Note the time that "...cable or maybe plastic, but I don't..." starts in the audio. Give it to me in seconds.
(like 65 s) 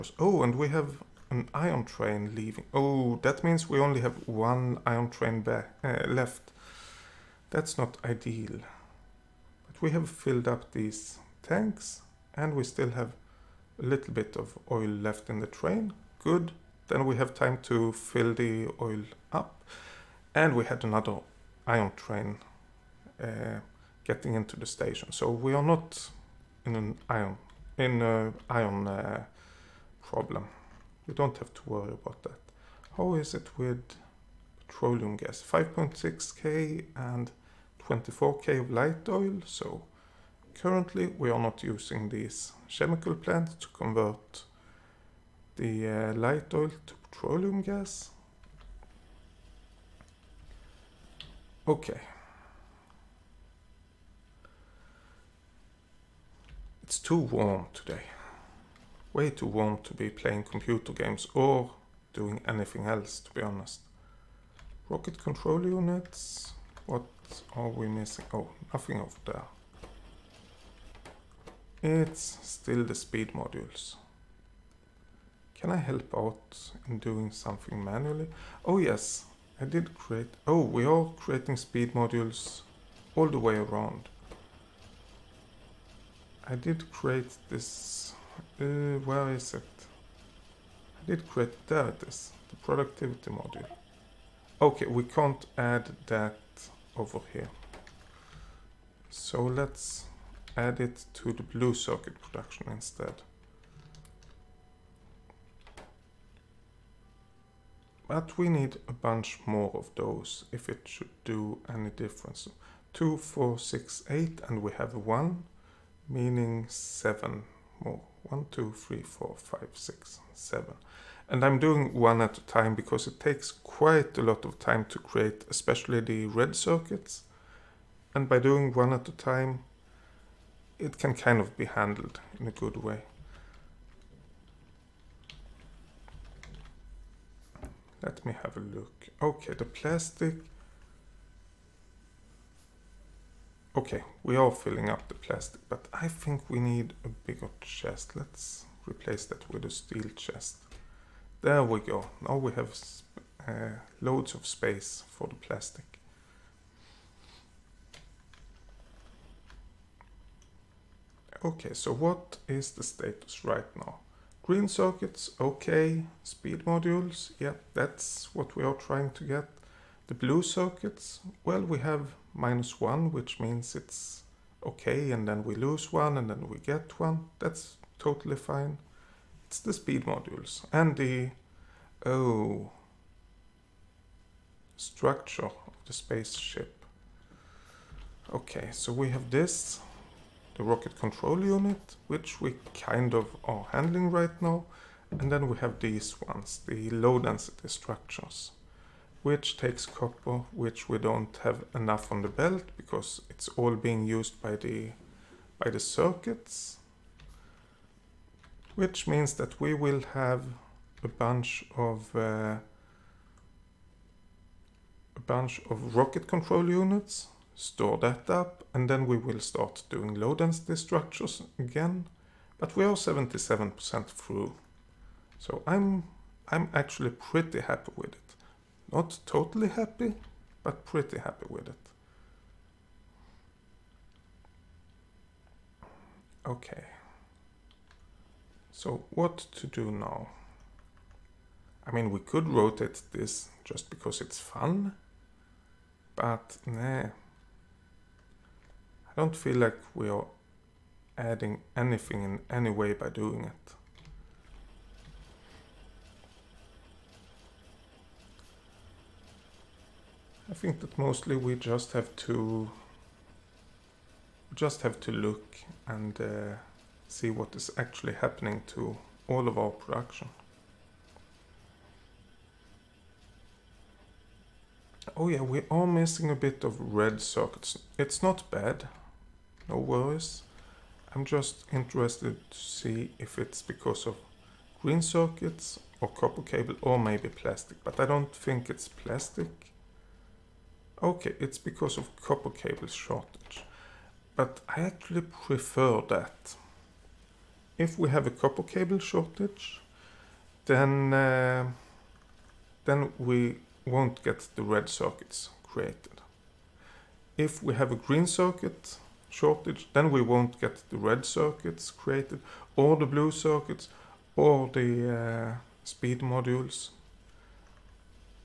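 286 s.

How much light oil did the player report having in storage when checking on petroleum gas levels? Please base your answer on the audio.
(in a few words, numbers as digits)
24k.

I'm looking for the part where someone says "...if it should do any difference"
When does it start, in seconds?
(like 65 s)
110 s.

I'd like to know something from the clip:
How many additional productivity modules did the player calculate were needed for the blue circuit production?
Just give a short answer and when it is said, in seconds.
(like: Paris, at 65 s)
7, at 116 s.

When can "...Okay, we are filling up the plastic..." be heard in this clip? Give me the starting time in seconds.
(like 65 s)
143 s.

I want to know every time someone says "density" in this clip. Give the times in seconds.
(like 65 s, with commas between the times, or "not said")
197 s, 220 s.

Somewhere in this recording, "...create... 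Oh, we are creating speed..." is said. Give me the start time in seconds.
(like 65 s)
79 s.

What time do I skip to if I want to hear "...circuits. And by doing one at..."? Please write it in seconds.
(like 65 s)
126 s.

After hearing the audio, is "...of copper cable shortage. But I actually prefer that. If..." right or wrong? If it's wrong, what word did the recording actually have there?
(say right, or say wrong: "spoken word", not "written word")
right.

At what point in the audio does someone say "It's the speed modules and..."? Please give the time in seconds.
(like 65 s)
179 s.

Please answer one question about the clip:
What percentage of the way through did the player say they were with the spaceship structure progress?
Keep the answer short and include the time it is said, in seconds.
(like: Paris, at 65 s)
77%, at 222 s.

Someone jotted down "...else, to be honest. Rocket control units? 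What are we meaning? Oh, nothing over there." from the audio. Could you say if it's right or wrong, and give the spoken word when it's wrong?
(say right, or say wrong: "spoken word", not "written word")
wrong: "missing", not "meaning".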